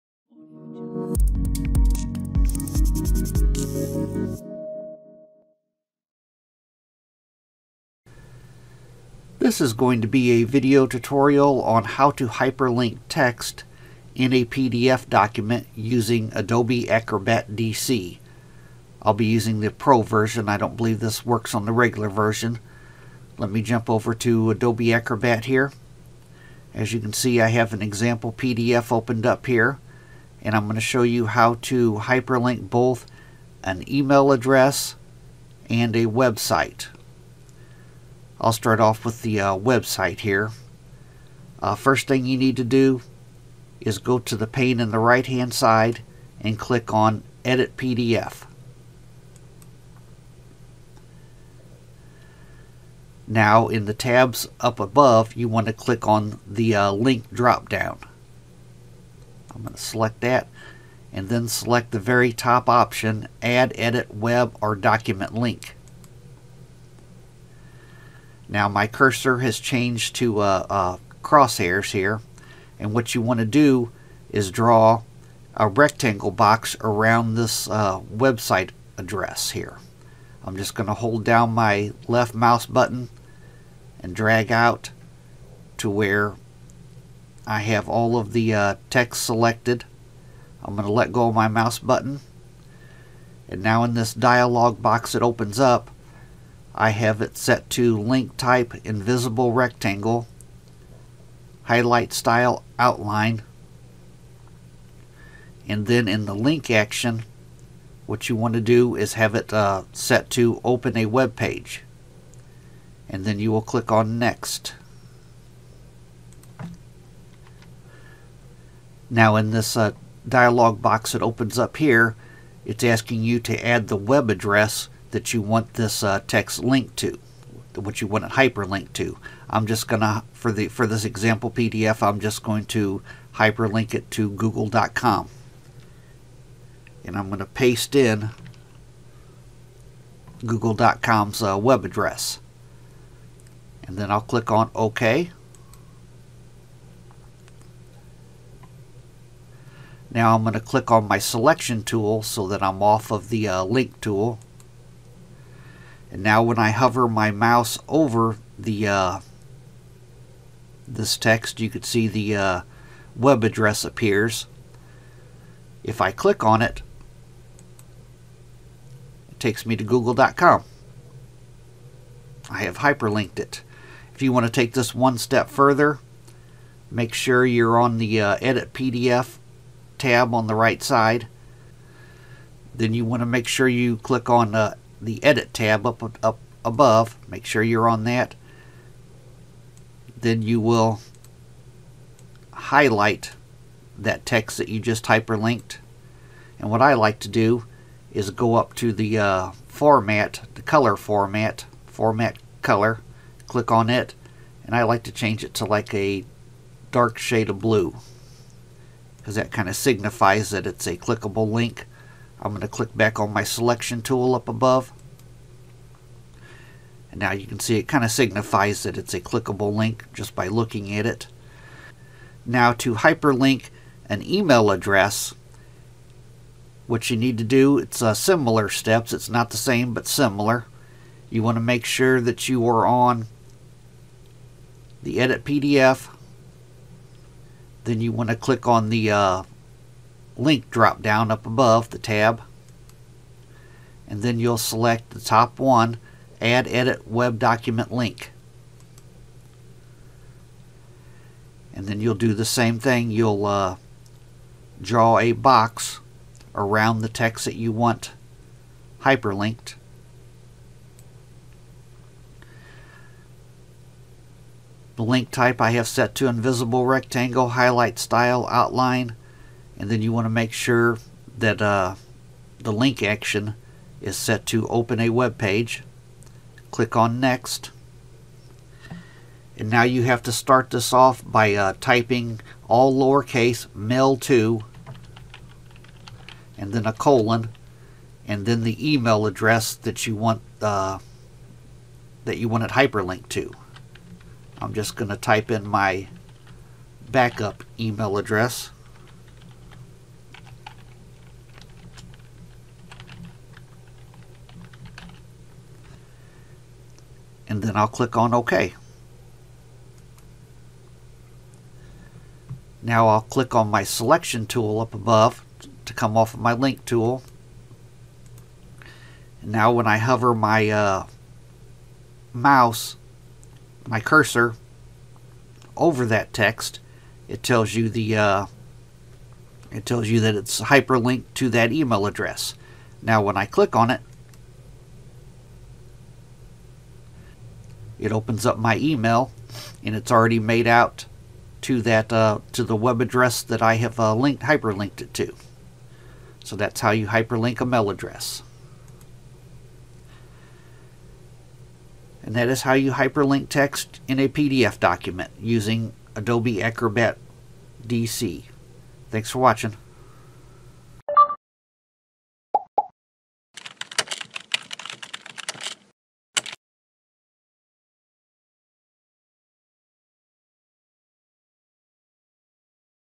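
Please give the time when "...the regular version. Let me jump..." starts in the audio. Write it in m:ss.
0:21.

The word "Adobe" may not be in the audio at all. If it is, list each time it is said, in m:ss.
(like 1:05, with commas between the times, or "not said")
0:16, 0:24, 5:56.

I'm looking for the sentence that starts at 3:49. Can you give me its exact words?
It's not the same, but similar.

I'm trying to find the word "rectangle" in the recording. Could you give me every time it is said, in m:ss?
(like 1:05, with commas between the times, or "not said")
1:15, 1:39, 4:26.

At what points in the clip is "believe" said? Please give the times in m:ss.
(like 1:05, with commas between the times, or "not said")
0:20.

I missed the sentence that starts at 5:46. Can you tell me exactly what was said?
So that's how you hyperlink a mail address.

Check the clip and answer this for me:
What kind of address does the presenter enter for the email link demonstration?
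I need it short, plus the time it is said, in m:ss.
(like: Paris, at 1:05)
Backup email, at 4:57.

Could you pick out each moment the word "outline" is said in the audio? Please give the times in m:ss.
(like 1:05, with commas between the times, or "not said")
1:42, 4:28.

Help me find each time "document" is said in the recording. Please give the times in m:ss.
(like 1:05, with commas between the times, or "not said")
0:15, 1:04, 4:07, 5:54.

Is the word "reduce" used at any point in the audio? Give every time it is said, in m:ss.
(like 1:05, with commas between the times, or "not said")
not said.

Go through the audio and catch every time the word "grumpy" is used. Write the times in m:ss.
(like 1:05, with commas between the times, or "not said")
not said.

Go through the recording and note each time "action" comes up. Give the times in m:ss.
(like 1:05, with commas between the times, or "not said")
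1:46, 4:33.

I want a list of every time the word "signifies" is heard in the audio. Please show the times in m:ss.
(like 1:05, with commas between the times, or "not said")
3:29, 3:38.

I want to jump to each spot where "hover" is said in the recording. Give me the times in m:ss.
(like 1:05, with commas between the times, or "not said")
2:36, 5:19.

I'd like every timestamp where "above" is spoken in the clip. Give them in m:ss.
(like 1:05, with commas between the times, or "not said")
0:54, 3:06, 3:34, 4:01, 5:14.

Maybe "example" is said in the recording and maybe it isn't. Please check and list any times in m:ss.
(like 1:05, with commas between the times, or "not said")
0:27, 2:11.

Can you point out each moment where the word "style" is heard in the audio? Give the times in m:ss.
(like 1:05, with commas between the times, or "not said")
1:42, 4:27.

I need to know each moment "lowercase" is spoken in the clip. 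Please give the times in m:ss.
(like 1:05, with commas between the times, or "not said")
4:42.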